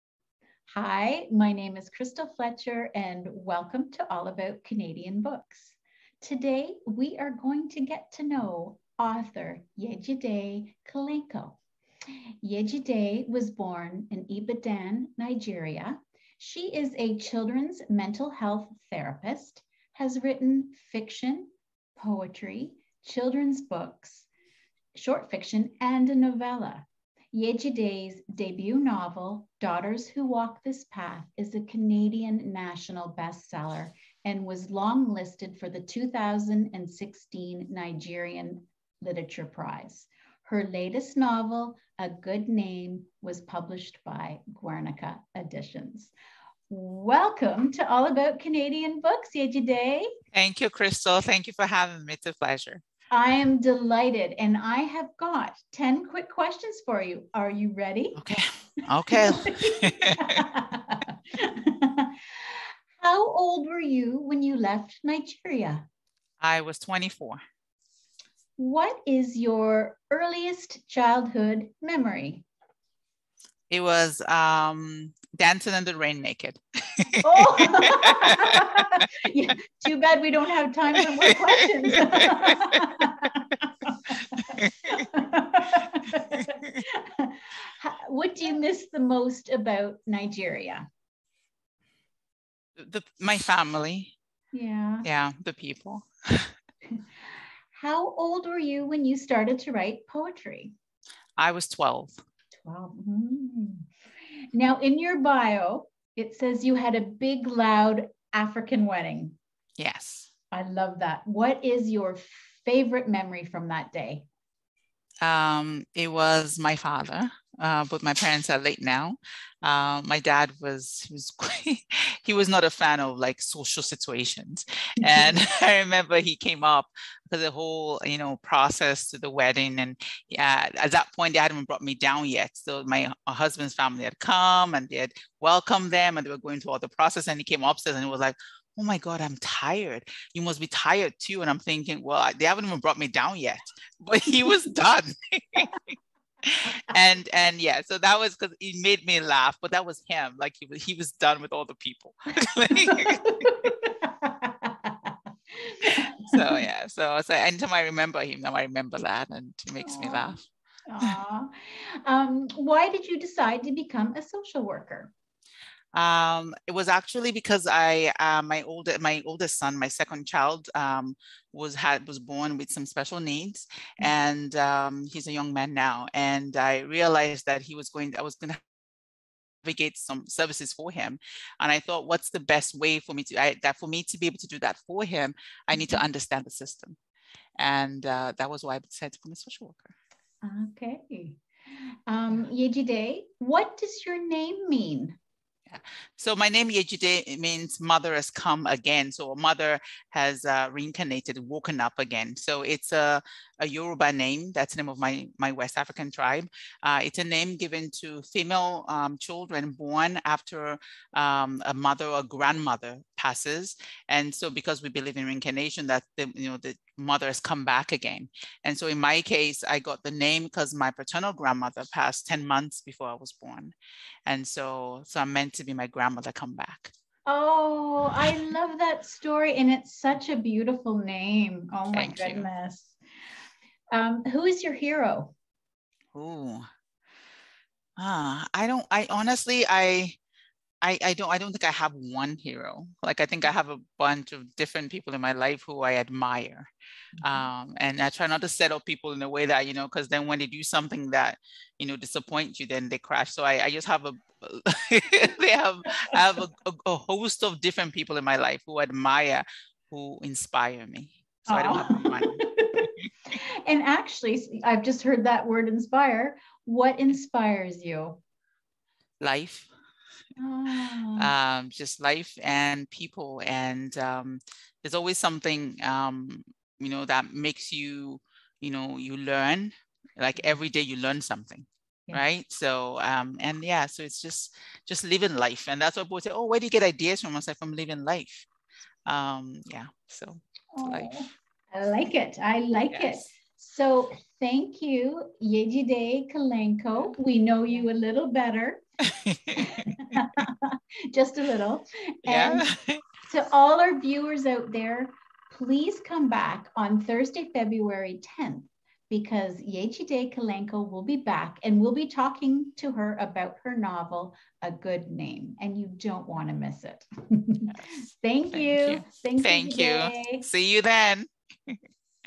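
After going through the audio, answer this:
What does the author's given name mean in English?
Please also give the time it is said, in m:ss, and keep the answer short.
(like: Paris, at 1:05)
Mother has come again, at 3:17.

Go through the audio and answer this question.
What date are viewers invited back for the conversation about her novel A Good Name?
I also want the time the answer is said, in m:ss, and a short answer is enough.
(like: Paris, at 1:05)
Thursday, February 10th, at 5:07.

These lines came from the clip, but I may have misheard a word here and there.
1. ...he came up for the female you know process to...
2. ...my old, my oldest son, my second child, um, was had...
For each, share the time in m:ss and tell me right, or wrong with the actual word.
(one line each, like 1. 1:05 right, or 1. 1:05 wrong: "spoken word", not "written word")
1. 2:06 wrong: "whole", not "female"
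2. 2:48 right.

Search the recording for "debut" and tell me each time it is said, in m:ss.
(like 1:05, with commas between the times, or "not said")
0:28.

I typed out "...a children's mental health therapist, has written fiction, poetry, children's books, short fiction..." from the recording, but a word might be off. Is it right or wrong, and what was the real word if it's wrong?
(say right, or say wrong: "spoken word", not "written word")
right.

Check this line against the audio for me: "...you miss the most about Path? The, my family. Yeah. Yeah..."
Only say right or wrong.
wrong.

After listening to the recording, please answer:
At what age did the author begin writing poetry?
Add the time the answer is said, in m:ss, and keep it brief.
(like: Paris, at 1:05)
12, at 1:41.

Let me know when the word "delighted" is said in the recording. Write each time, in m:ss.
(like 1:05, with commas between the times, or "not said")
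0:53.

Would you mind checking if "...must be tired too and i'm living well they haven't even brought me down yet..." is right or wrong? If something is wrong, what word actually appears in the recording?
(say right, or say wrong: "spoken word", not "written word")
wrong: "thinking", not "living".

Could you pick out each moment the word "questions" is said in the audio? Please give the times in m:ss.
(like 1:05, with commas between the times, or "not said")
0:56, 1:21.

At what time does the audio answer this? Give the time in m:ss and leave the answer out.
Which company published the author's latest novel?
0:44.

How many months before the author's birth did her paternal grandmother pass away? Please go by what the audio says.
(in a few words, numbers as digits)
10.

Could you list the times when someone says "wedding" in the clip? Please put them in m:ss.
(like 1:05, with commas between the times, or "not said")
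1:48, 2:09.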